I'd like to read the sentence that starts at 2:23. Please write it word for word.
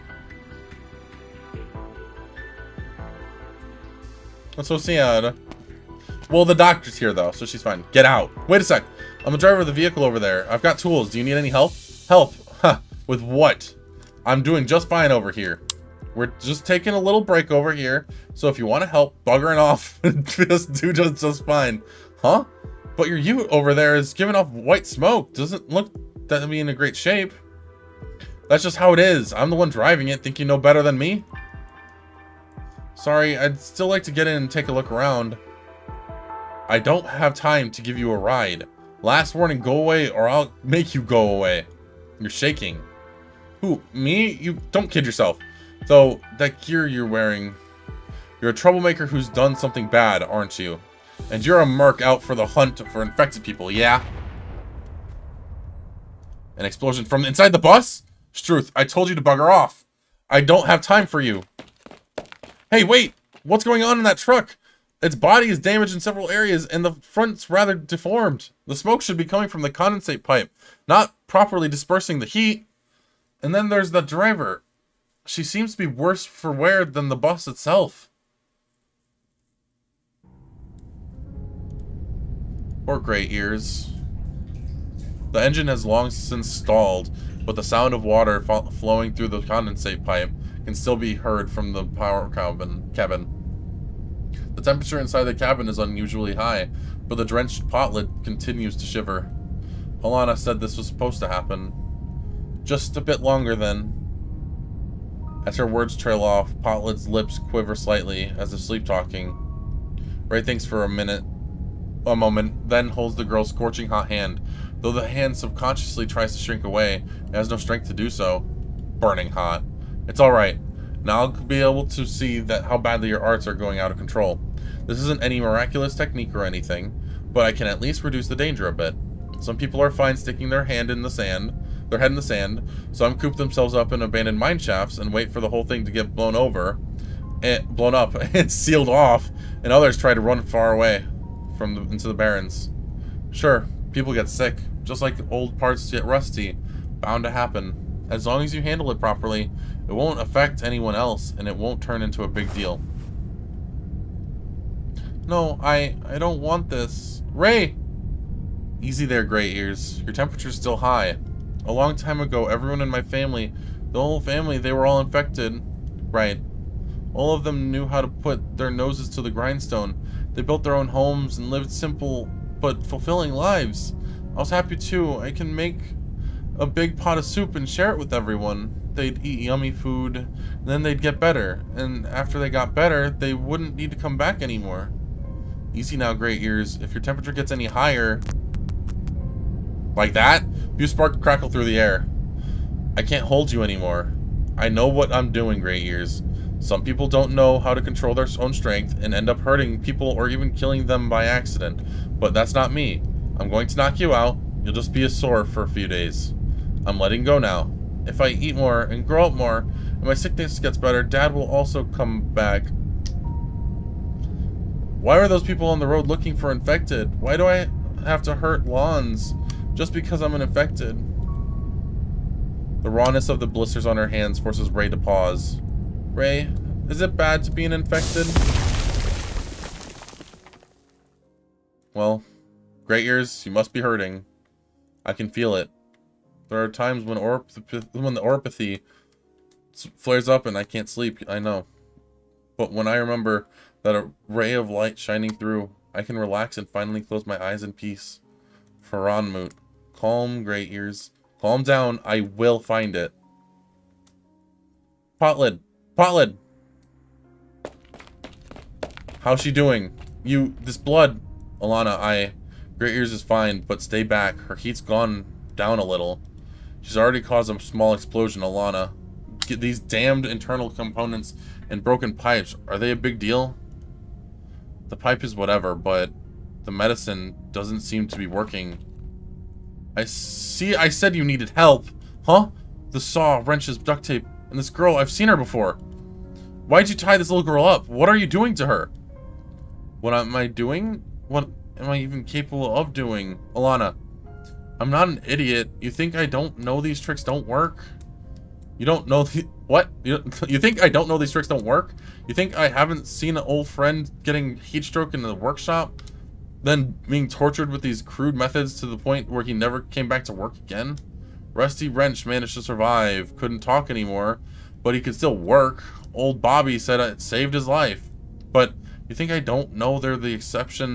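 Sure, people get sick, just like old parts get rusty.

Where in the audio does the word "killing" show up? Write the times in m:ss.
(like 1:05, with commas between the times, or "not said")
3:20.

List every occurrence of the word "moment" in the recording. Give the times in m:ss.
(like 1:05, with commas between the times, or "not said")
1:52.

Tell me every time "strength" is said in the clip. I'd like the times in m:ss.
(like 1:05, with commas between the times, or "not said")
1:57, 3:18.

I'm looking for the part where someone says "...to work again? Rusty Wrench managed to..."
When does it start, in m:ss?
5:10.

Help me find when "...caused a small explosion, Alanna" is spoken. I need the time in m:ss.
4:27.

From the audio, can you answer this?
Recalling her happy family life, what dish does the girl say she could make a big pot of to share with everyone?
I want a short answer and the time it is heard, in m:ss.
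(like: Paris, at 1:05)
soup, at 2:57.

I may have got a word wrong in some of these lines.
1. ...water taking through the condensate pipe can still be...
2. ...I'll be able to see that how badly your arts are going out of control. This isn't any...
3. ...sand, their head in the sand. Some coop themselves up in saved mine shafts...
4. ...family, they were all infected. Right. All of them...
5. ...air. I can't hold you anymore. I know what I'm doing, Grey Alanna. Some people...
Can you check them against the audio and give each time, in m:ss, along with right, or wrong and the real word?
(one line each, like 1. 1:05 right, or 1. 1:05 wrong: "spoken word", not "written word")
1. 1:28 wrong: "flowing", not "taking"
2. 2:01 right
3. 2:11 wrong: "abandoned", not "saved"
4. 2:44 right
5. 3:11 wrong: "Ears", not "Alanna".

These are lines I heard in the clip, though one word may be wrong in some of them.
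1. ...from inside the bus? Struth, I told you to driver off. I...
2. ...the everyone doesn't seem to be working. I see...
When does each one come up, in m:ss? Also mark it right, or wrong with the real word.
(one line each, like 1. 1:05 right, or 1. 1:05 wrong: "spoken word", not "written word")
1. 0:57 wrong: "bugger", not "driver"
2. 4:36 wrong: "medicine", not "everyone".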